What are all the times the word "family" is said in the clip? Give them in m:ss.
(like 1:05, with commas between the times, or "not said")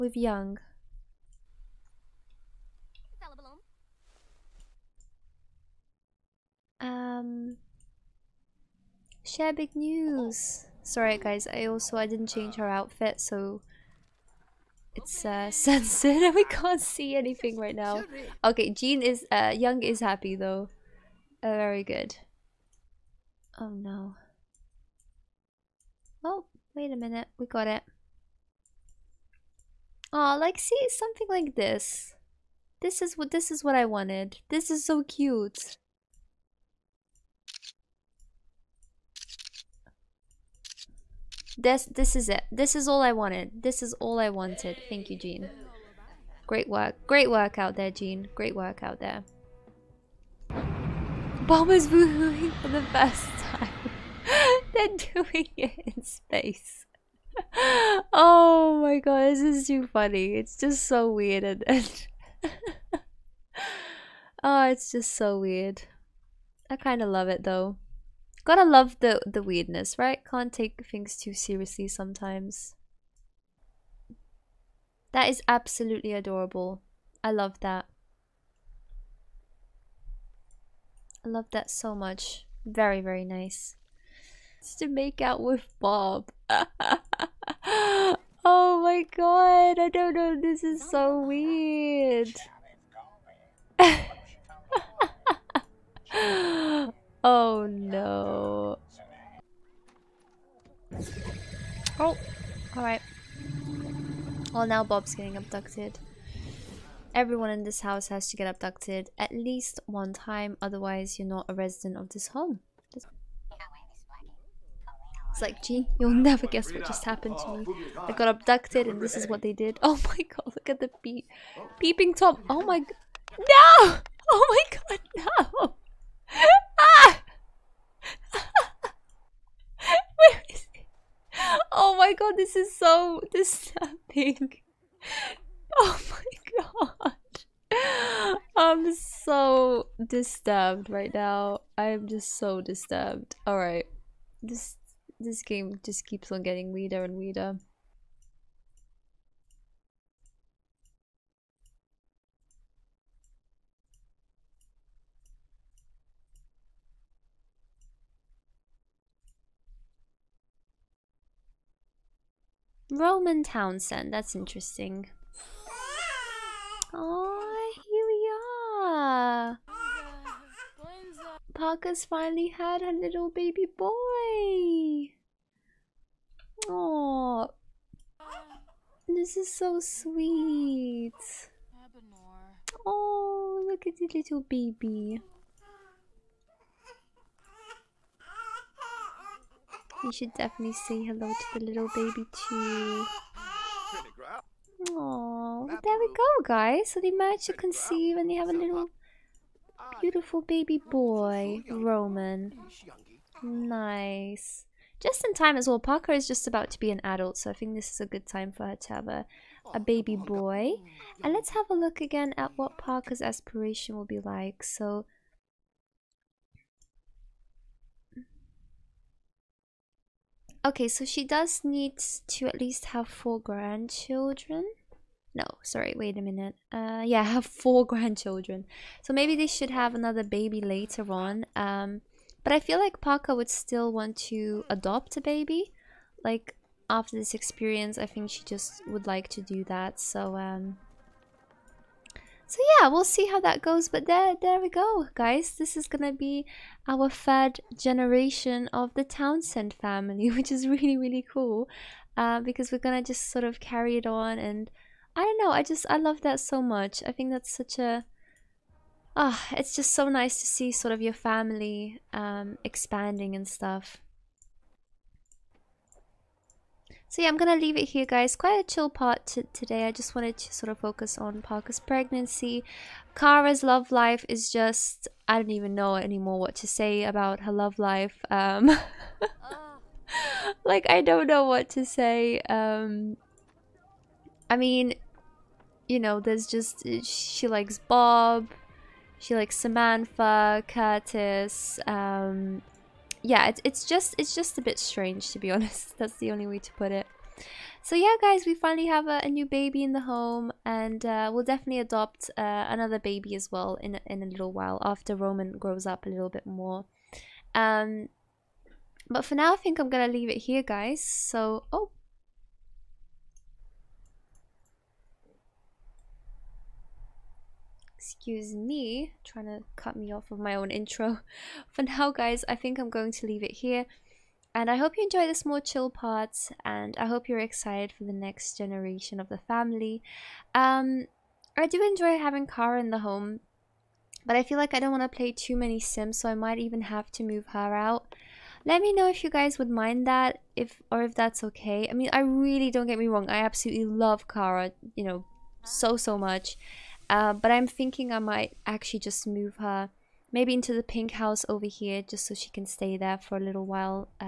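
4:09, 4:21, 5:29.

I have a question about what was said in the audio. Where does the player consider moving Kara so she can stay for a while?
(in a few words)
the pink house.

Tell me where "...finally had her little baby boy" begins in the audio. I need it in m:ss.
2:52.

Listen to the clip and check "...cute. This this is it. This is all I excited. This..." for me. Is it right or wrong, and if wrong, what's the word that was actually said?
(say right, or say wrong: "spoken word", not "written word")
wrong: "wanted", not "excited".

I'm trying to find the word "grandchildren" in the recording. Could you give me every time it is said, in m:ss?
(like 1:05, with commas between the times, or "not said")
3:43, 3:47.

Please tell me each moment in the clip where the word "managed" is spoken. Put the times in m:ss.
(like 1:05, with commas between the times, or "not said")
3:17.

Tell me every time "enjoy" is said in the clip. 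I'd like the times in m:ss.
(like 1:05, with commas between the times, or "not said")
5:25, 5:31.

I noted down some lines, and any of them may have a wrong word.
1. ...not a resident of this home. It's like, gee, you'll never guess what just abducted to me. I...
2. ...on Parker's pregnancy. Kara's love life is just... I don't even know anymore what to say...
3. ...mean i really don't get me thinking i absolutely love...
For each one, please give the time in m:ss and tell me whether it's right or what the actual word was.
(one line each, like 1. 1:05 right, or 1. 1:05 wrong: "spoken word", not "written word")
1. 1:51 wrong: "happened", not "abducted"
2. 4:31 right
3. 5:41 wrong: "wrong", not "thinking".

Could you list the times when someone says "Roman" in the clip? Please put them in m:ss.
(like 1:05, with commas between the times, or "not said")
2:42, 3:21, 5:05.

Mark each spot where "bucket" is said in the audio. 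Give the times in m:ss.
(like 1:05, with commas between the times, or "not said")
not said.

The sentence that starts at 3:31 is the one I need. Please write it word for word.
And let's have a look again at what Parker's aspiration will be like.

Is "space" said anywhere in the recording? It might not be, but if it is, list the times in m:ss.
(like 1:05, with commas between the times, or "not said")
0:56.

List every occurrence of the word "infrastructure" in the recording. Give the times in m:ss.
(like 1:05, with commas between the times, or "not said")
not said.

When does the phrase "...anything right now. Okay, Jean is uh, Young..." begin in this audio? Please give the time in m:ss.
0:17.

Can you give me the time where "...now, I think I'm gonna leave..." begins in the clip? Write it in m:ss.
5:09.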